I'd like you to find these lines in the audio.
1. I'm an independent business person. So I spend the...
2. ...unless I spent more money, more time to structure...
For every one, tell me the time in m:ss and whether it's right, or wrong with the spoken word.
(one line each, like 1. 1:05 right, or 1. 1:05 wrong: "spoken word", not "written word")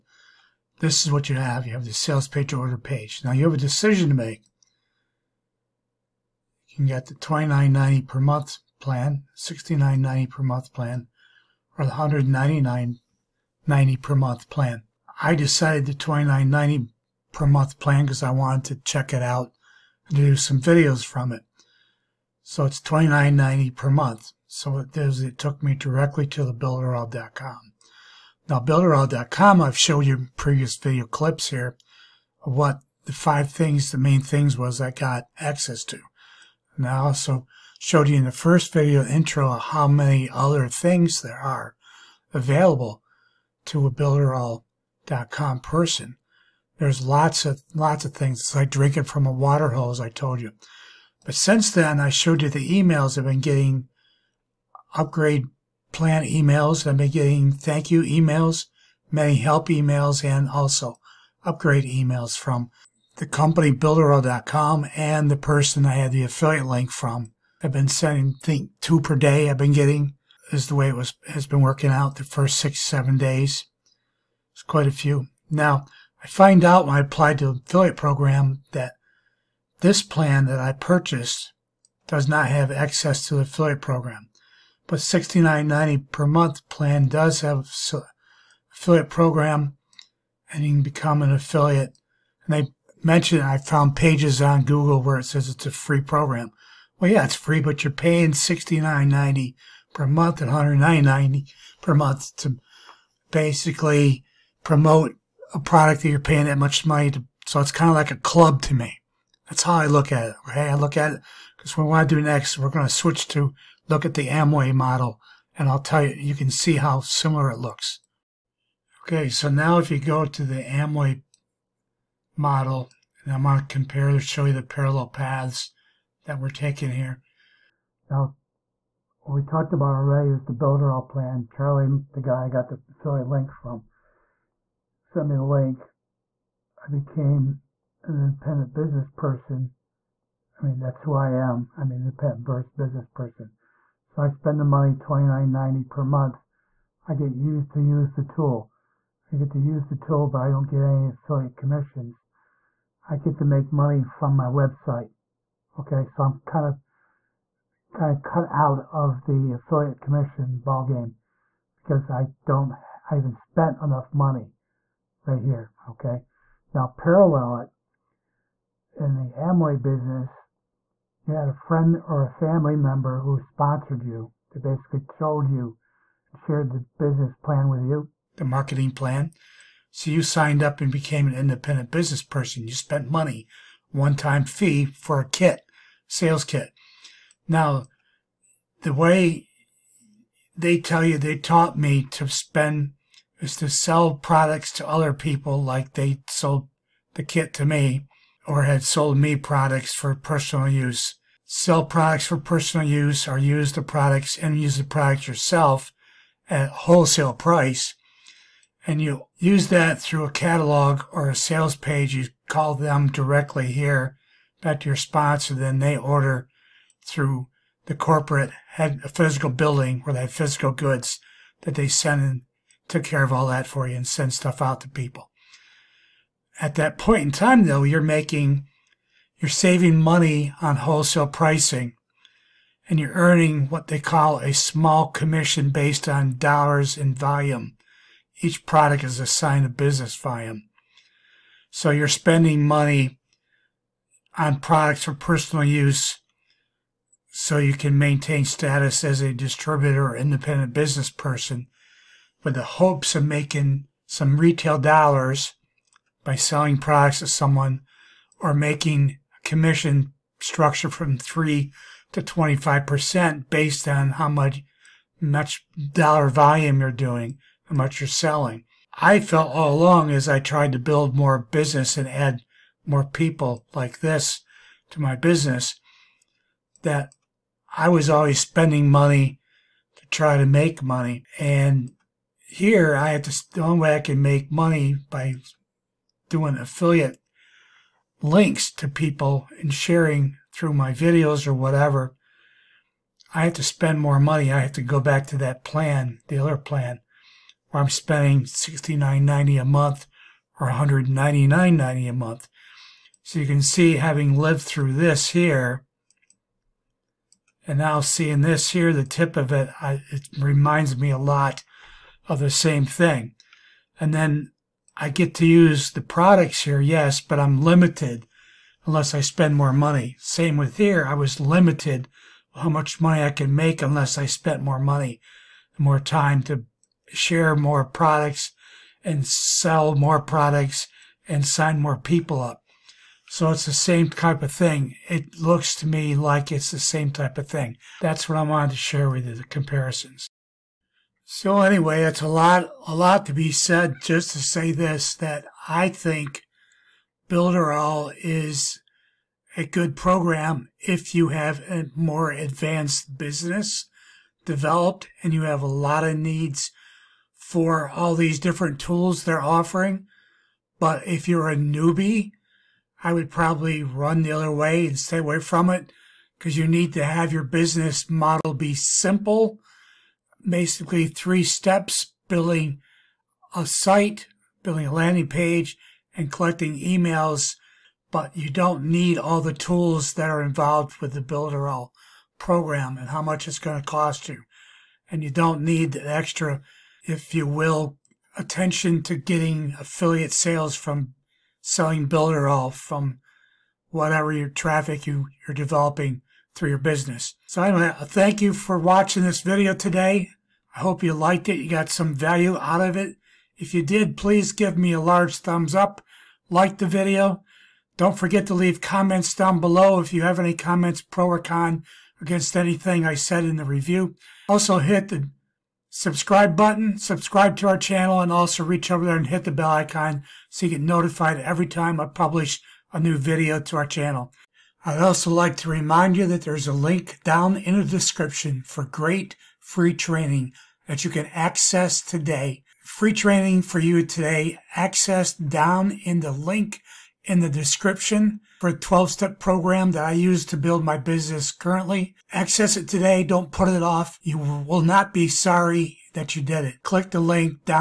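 1. 2:21 right
2. 5:23 wrong: "share", not "structure".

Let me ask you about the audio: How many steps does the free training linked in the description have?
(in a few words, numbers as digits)
12.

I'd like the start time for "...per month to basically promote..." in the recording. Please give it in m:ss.
1:41.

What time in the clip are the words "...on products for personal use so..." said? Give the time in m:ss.
4:04.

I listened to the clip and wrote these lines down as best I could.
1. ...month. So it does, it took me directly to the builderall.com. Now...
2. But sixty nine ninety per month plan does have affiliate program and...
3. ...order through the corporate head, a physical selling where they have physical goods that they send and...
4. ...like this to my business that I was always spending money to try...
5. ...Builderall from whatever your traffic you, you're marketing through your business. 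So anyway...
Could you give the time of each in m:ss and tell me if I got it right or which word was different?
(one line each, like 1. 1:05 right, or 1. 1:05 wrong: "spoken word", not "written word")
1. 0:23 right
2. 1:24 right
3. 3:35 wrong: "building", not "selling"
4. 4:33 right
5. 6:32 wrong: "developing", not "marketing".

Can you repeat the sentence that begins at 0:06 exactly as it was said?
You can get the $29.90 per month plan, $69.90 per month plan, or the 199.90 per month plan.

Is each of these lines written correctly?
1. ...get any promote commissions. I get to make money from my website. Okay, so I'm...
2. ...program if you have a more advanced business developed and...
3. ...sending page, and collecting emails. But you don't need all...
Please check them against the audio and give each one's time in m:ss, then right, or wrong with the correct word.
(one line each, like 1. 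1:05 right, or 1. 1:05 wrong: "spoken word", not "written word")
1. 2:30 wrong: "affiliate", not "promote"
2. 5:49 right
3. 6:14 wrong: "landing", not "sending".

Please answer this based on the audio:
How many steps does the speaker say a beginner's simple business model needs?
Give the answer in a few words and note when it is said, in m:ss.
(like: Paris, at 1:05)
three, at 6:11.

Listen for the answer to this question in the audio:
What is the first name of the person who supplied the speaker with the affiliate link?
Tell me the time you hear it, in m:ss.
2:11.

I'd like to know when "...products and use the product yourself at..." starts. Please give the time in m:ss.
3:23.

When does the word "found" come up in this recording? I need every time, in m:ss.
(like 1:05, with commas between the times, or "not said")
1:33.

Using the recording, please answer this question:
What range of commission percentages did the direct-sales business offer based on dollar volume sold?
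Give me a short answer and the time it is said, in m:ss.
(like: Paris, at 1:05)
3 to 25%, at 4:21.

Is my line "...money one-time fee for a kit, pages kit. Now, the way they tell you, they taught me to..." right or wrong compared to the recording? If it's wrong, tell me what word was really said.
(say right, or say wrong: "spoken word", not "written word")
wrong: "sales", not "pages".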